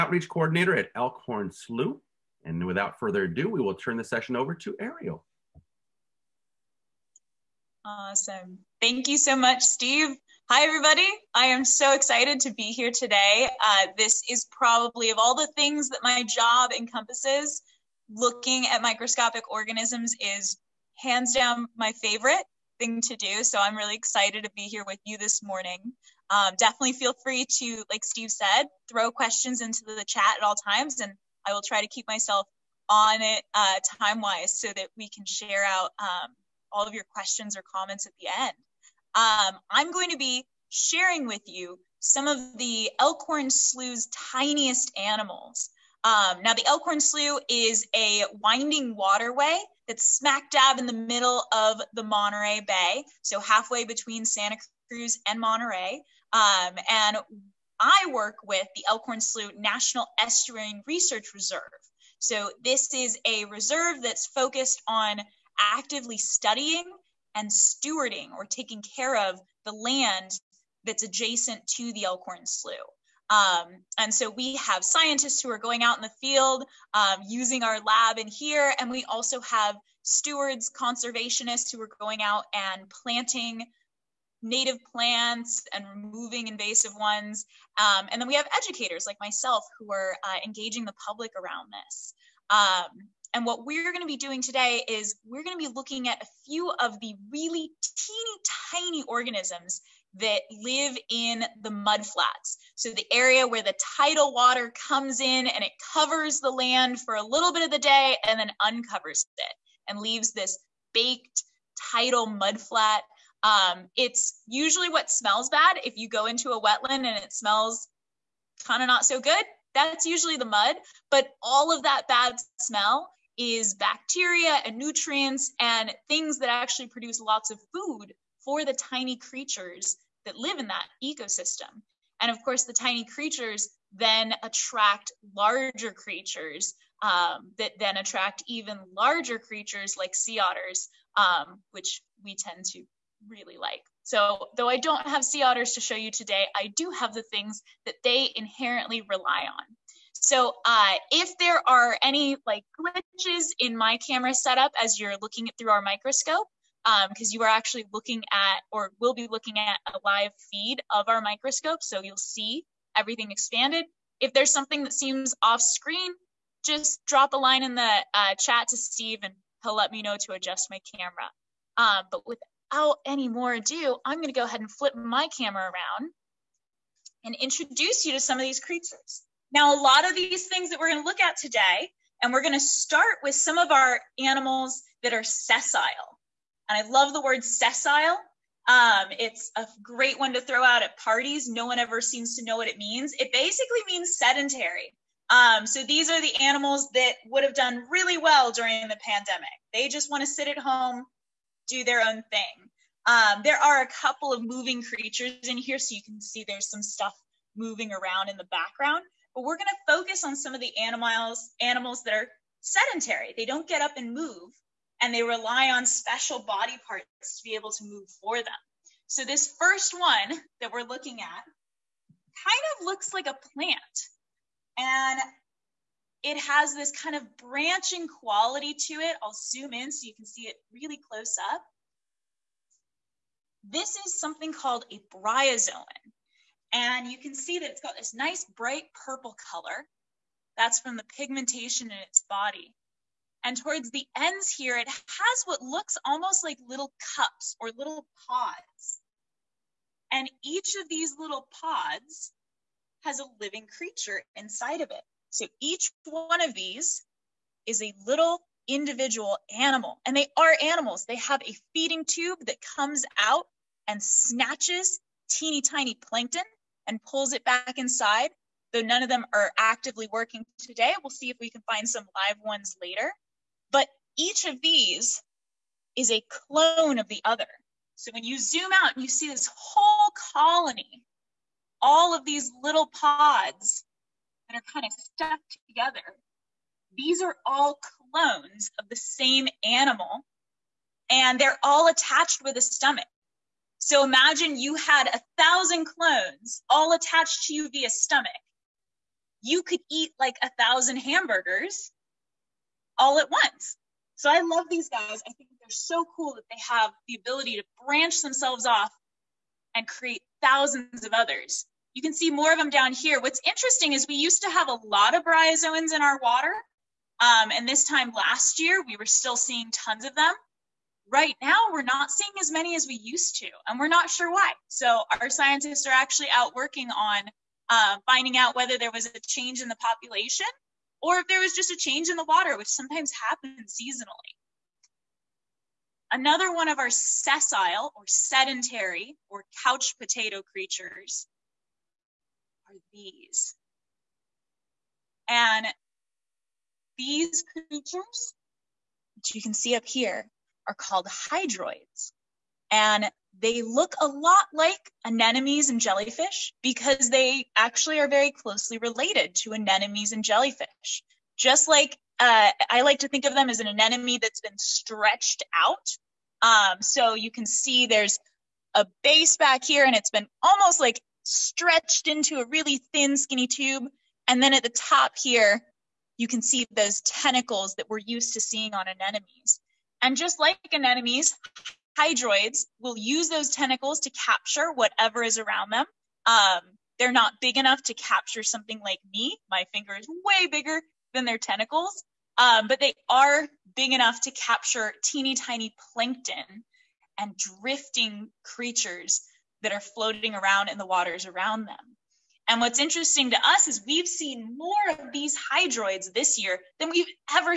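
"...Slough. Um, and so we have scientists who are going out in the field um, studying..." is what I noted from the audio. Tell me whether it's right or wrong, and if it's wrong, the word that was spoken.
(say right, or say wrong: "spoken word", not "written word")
wrong: "using", not "studying".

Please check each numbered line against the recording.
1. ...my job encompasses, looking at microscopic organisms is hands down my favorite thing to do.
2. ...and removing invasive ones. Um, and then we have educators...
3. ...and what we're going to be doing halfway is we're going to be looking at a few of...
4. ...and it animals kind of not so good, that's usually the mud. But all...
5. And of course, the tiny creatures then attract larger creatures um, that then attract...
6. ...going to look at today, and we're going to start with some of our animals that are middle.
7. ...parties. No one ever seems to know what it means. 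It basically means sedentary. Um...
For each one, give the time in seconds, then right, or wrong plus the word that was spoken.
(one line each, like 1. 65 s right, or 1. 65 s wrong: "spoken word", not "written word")
1. 16 s right
2. 85 s right
3. 93 s wrong: "today", not "halfway"
4. 117 s wrong: "smells", not "animals"
5. 132 s right
6. 180 s wrong: "sessile", not "middle"
7. 190 s right.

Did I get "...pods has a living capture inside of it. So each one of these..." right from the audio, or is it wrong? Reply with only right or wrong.
wrong.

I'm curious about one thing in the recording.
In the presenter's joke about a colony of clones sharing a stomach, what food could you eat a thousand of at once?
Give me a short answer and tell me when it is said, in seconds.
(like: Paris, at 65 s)
Hamburgers, at 300 s.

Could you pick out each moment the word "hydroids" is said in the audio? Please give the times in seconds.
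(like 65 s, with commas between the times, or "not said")
351 s, 381 s, 405 s.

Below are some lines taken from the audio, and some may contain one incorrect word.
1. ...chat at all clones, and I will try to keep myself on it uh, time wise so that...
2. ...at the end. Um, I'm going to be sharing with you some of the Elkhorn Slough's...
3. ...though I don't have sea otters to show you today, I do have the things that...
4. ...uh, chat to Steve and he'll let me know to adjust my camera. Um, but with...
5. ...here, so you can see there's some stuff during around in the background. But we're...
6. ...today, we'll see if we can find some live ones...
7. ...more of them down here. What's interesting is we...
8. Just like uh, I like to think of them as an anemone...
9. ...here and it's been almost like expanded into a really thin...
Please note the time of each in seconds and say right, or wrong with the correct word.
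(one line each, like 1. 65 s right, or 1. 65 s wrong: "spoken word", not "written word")
1. 30 s wrong: "times", not "clones"
2. 38 s right
3. 144 s right
4. 168 s right
5. 205 s wrong: "moving", not "during"
6. 270 s right
7. 312 s right
8. 361 s right
9. 369 s wrong: "stretched", not "expanded".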